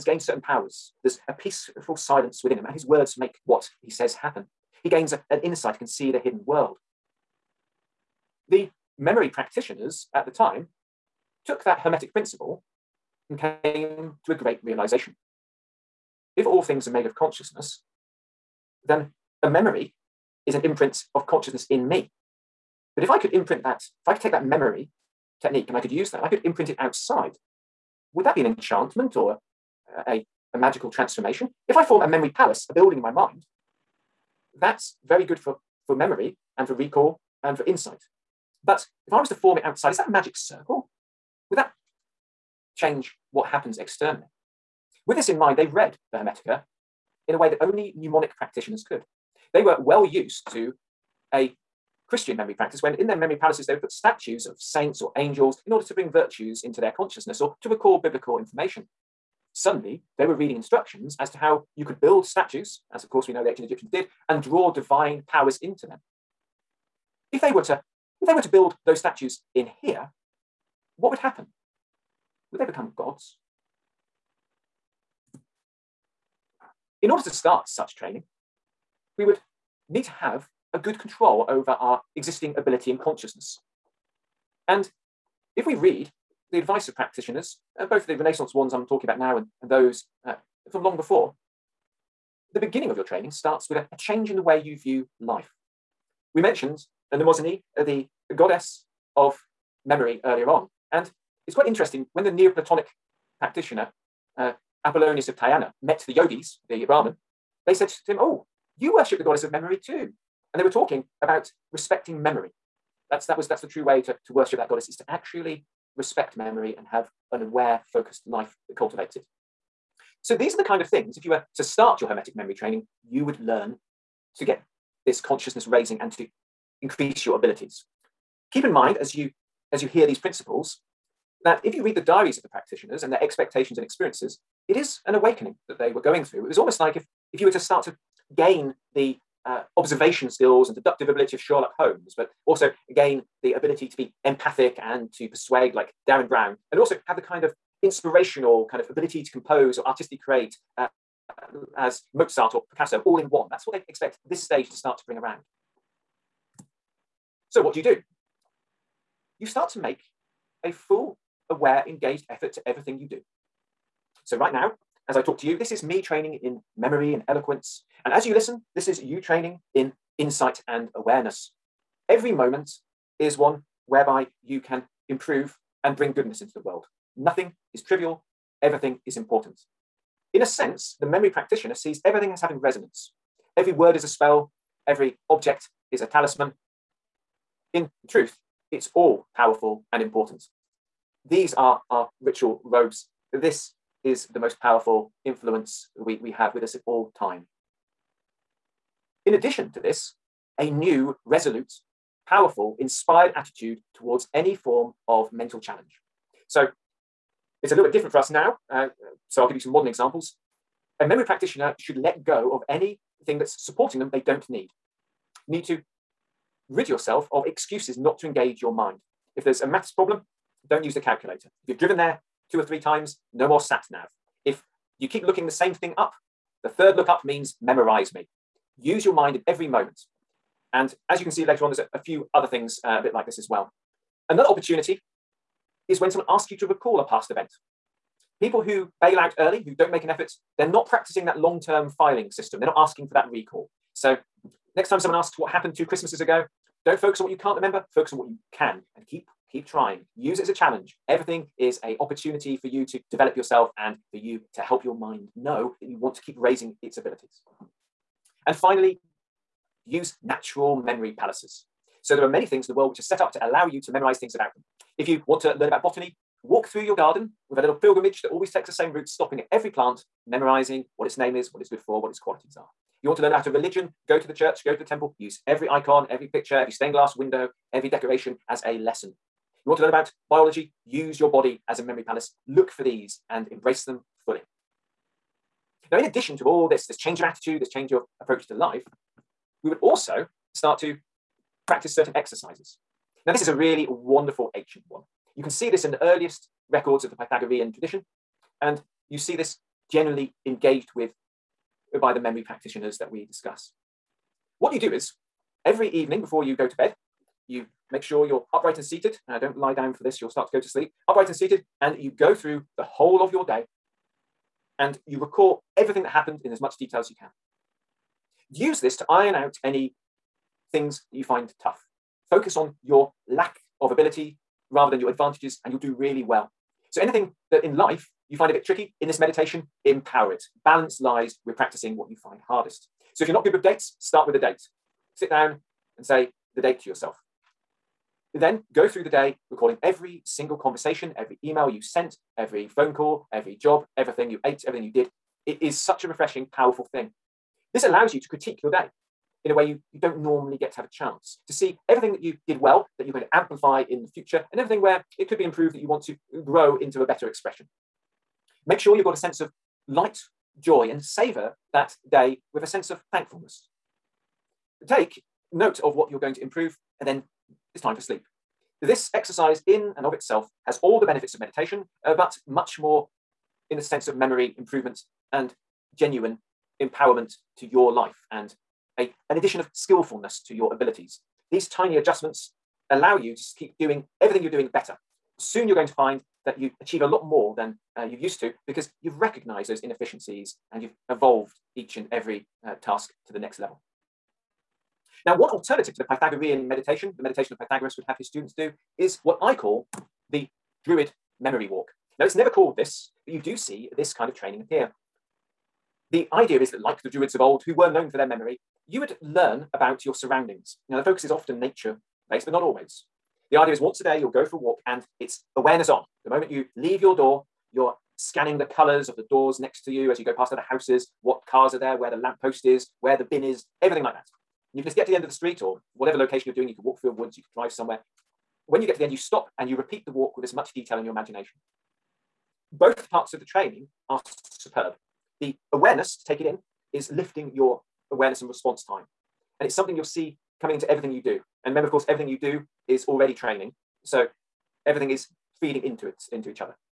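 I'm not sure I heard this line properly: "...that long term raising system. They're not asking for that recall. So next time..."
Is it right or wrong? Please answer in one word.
wrong.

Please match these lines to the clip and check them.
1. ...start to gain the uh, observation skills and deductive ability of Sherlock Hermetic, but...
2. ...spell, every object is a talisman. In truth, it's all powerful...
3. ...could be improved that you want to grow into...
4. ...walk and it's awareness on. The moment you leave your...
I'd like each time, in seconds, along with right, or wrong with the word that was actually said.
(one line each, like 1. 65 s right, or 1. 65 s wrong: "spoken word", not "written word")
1. 137 s wrong: "Holmes", not "Hermetic"
2. 184 s right
3. 355 s right
4. 414 s right.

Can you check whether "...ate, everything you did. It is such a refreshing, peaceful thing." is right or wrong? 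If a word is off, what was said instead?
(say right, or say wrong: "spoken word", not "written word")
wrong: "powerful", not "peaceful".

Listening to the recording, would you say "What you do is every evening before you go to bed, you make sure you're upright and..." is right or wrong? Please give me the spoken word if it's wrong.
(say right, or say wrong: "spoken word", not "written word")
right.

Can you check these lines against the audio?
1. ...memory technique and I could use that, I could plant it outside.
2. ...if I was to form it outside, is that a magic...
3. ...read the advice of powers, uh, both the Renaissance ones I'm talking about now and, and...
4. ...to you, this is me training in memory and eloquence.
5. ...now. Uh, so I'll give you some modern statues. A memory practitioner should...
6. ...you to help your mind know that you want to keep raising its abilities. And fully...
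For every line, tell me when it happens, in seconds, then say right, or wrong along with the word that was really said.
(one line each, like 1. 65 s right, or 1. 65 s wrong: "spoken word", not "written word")
1. 24 s wrong: "imprint", not "plant"
2. 39 s right
3. 85 s wrong: "practitioners", not "powers"
4. 165 s right
5. 208 s wrong: "examples", not "statues"
6. 254 s wrong: "finally", not "fully".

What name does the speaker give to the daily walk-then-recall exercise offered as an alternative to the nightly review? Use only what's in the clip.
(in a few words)
Druid memory walk.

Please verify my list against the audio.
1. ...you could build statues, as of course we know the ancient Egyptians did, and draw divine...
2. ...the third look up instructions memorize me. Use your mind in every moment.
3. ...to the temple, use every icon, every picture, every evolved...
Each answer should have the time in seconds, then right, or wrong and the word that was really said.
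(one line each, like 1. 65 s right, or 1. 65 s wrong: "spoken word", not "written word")
1. 61 s right
2. 226 s wrong: "means", not "instructions"
3. 274 s wrong: "stained", not "evolved".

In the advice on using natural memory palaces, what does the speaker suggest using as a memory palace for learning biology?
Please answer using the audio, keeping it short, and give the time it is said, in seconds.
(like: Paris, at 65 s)
Your body, at 281 s.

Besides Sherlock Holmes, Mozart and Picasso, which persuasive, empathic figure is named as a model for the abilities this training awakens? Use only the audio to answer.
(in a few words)
Derren Brown.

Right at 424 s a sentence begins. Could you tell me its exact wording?
And you can just get to the end of the street or whatever location you're doing.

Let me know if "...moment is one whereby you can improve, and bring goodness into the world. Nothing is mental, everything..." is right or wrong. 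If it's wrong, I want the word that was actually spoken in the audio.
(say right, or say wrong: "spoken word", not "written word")
wrong: "trivial", not "mental".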